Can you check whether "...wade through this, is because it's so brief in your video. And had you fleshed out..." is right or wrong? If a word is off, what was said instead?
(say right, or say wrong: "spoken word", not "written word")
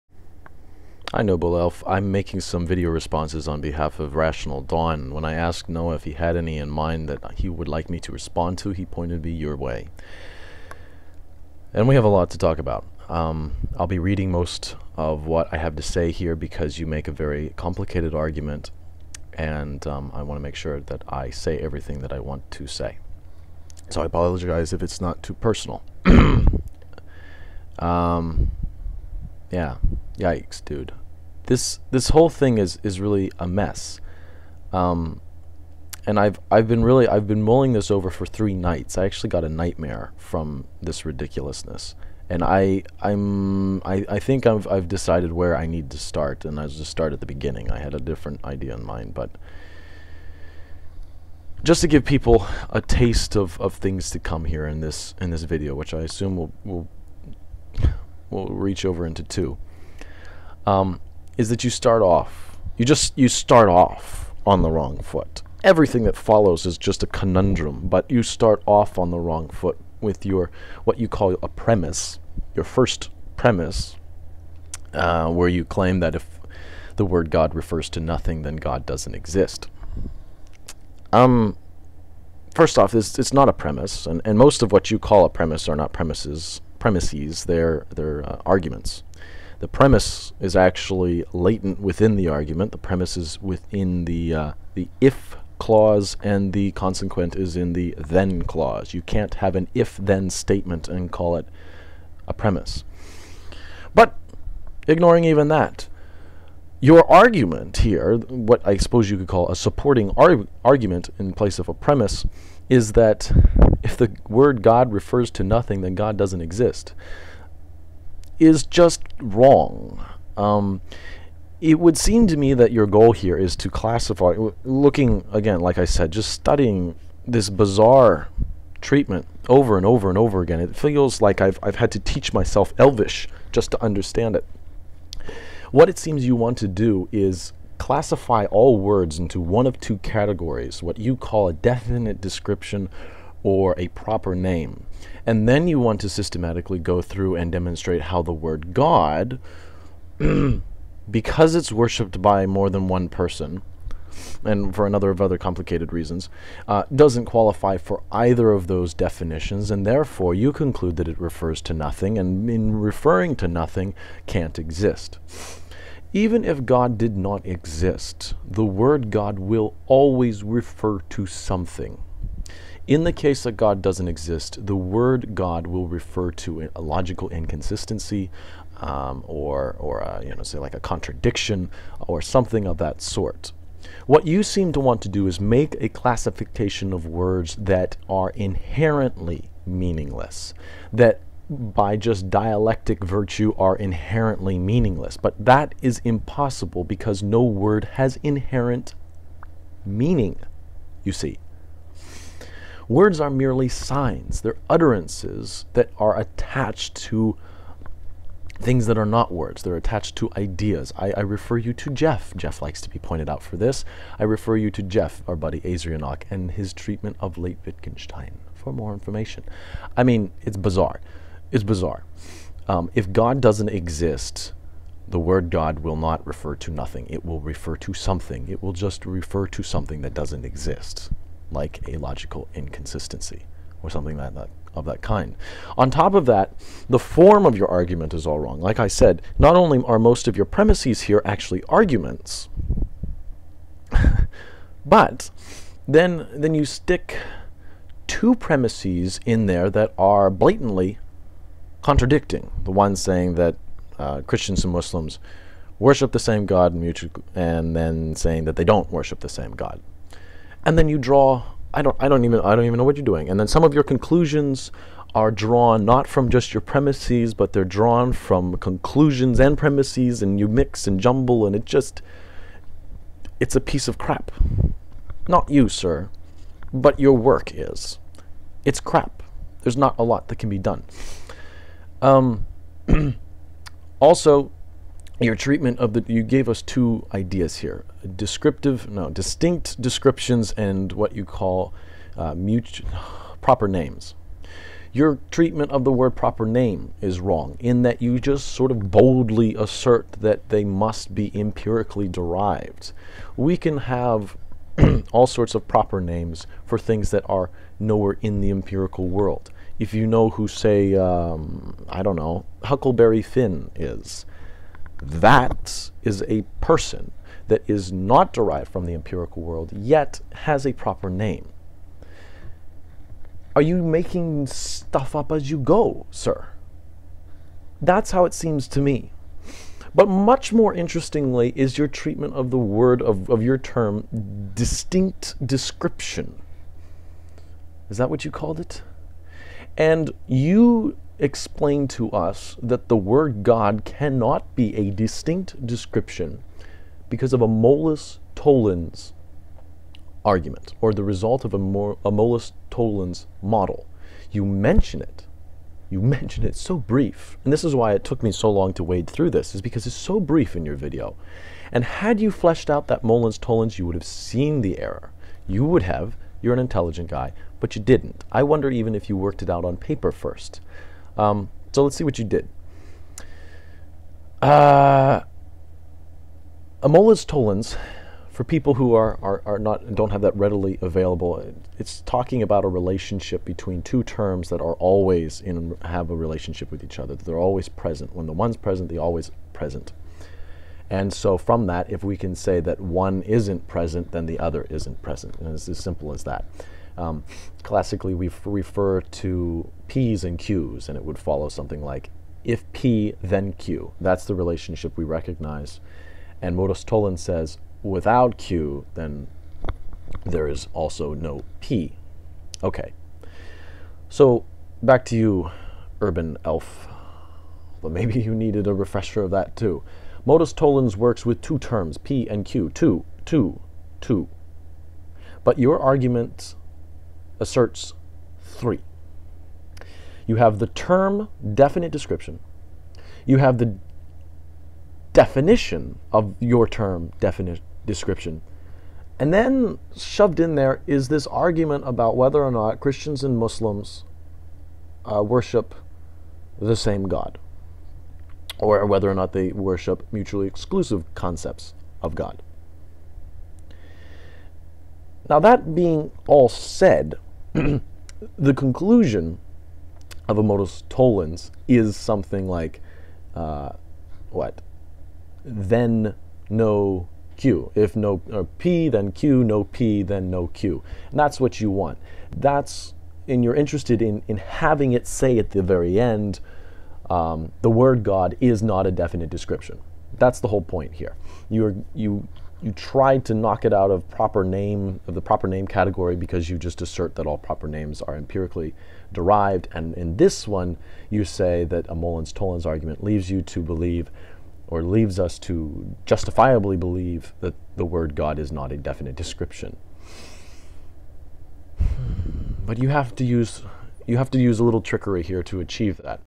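right.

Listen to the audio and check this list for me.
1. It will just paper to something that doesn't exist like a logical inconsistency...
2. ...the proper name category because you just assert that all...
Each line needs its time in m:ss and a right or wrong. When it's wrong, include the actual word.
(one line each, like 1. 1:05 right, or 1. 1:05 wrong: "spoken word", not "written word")
1. 3:48 wrong: "refer", not "paper"
2. 8:05 right.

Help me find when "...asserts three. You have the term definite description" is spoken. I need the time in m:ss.
7:07.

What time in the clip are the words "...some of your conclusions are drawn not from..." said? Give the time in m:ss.
4:23.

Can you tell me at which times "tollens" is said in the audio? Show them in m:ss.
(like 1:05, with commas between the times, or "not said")
5:48, 5:52, 6:03, 6:46, 7:00, 7:40, 8:12.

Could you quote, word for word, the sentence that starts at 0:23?
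So I apologize if it's not too personal.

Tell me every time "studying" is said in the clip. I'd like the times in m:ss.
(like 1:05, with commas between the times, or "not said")
2:06.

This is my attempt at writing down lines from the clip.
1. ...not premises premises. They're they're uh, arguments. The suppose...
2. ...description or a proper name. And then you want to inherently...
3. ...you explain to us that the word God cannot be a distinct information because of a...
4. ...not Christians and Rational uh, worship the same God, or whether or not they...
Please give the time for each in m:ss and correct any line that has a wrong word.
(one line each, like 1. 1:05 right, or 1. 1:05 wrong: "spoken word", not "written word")
1. 1:25 wrong: "premise", not "suppose"
2. 2:22 wrong: "systematically", not "inherently"
3. 5:40 wrong: "description", not "information"
4. 7:22 wrong: "Muslims", not "Rational".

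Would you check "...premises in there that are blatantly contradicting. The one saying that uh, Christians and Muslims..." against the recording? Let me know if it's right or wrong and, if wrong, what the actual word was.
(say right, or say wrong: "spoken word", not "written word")
right.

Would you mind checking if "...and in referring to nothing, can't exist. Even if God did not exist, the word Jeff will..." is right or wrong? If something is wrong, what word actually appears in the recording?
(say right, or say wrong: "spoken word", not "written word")
wrong: "God", not "Jeff".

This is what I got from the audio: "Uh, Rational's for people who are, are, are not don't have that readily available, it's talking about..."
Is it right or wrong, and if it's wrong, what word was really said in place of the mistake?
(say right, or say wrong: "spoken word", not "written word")
wrong: "Amola", not "Rational".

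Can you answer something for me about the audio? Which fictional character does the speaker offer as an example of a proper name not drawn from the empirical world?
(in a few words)
Huckleberry Finn.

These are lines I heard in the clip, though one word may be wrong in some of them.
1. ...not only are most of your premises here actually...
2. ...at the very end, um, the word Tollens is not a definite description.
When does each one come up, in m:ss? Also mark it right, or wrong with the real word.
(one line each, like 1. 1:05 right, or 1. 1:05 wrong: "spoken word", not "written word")
1. 3:59 right
2. 7:55 wrong: "God", not "Tollens".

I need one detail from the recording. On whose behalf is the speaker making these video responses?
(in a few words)
Rational Dawn.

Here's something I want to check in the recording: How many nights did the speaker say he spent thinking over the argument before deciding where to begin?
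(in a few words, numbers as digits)
3.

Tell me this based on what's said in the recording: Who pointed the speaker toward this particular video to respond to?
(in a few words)
Noah.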